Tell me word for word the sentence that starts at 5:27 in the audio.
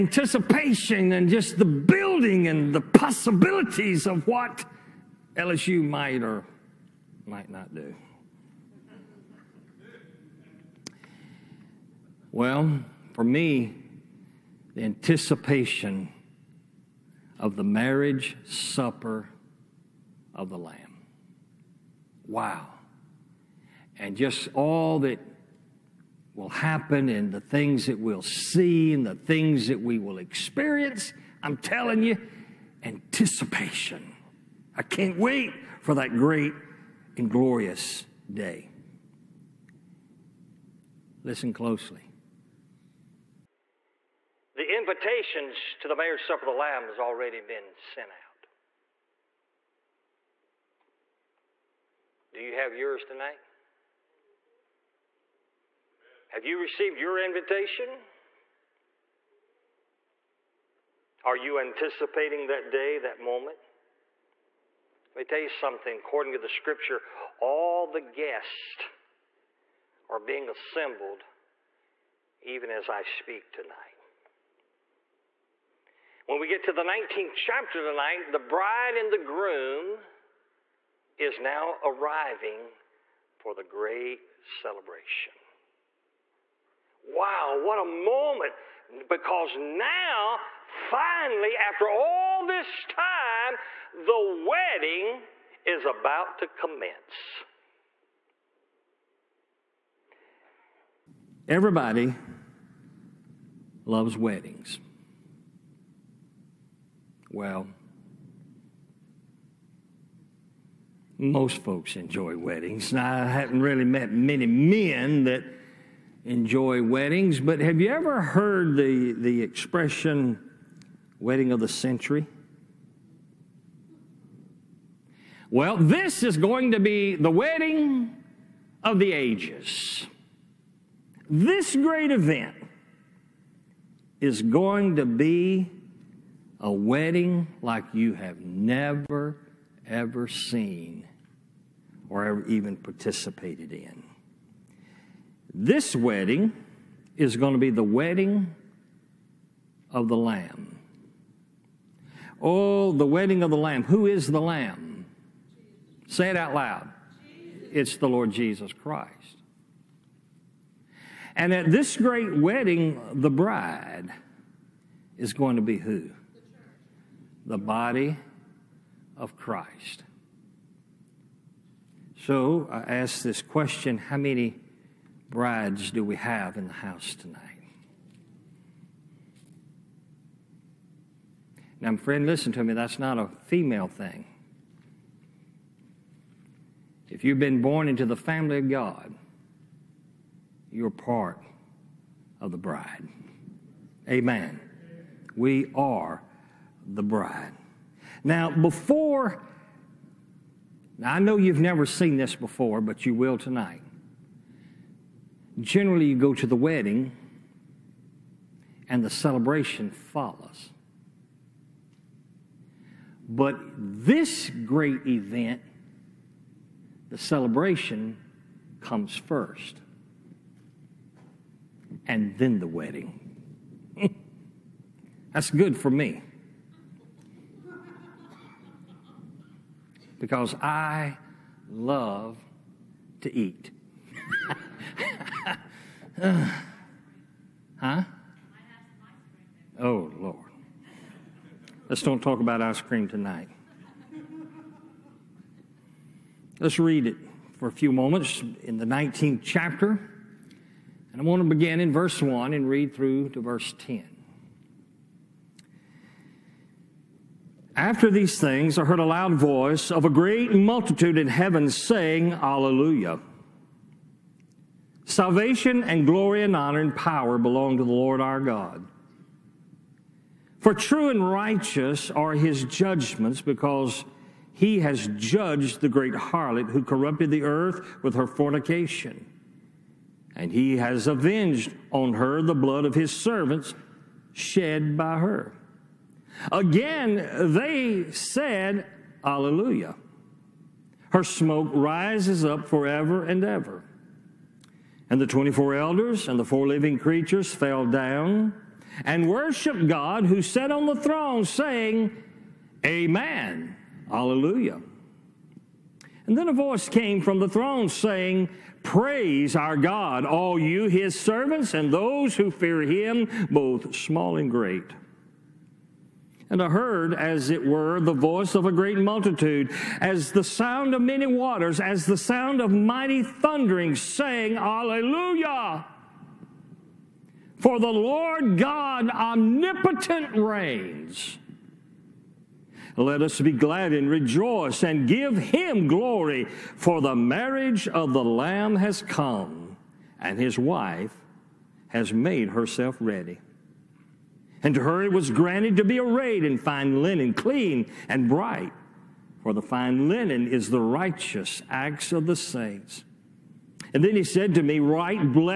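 For the Lord God omnipotent reigns.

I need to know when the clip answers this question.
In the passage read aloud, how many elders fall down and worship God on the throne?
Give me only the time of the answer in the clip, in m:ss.
4:55.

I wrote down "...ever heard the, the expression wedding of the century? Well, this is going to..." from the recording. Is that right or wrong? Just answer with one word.
right.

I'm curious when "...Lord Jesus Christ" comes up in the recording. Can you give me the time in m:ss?
2:38.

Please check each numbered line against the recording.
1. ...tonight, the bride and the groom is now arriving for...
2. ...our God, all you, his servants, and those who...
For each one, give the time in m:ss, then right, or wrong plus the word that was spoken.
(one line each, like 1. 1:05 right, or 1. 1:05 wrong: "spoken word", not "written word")
1. 1:17 right
2. 5:09 right.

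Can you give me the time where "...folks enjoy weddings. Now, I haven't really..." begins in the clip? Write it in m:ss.
1:51.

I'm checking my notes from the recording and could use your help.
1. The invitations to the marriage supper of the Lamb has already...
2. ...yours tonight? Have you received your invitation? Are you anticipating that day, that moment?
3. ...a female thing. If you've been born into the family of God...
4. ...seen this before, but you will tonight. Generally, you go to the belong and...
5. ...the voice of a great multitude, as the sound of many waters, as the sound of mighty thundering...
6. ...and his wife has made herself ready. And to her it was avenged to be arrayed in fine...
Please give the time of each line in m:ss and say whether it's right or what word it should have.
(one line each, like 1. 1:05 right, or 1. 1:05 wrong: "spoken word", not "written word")
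1. 0:44 right
2. 0:52 right
3. 3:03 right
4. 3:21 wrong: "wedding", not "belong"
5. 5:17 right
6. 5:40 wrong: "granted", not "avenged".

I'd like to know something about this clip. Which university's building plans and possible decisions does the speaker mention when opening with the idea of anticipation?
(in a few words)
LSU.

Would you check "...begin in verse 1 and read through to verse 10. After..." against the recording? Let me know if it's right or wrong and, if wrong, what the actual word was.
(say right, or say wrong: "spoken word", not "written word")
right.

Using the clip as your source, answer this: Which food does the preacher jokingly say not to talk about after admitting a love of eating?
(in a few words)
Ice cream.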